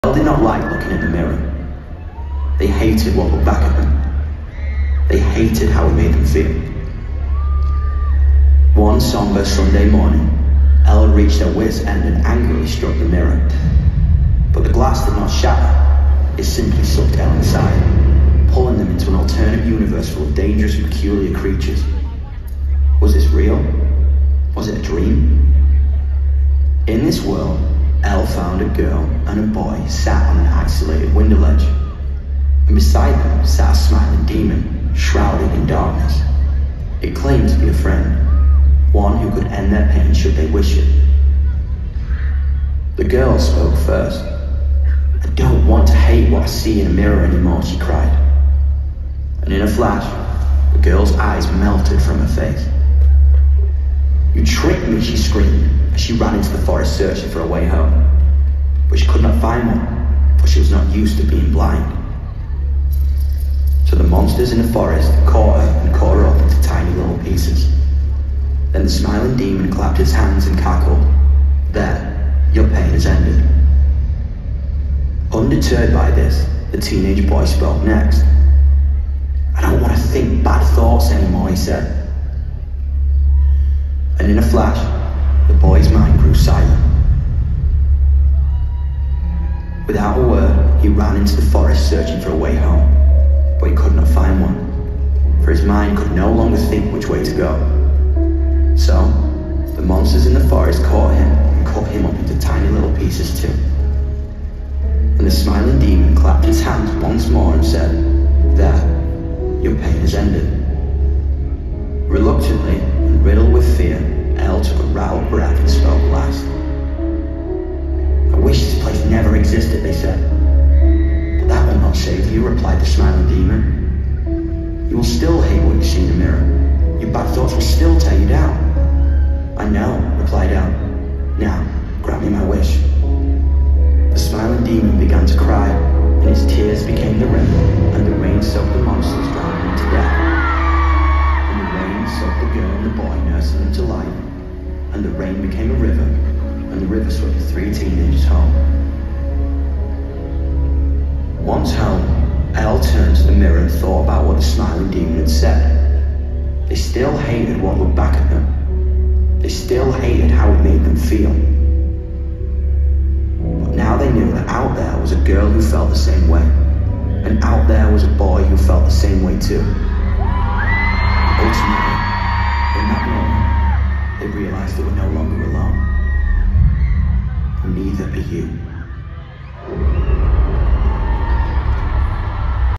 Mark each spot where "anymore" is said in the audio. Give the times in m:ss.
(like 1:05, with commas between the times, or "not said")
0:47, 1:21.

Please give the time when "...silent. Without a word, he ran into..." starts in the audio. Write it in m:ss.
1:26.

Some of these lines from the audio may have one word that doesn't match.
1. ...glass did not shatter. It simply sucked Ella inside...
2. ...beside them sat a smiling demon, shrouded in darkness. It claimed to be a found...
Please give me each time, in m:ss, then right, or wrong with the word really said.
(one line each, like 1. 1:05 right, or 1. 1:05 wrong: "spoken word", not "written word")
1. 0:14 right
2. 0:32 wrong: "friend", not "found".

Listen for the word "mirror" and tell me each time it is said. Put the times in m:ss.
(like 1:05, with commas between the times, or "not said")
0:01, 0:13, 0:46, 2:33.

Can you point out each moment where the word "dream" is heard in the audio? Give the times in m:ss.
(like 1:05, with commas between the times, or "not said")
0:24.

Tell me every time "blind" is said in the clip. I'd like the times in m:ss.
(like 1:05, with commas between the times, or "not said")
1:01.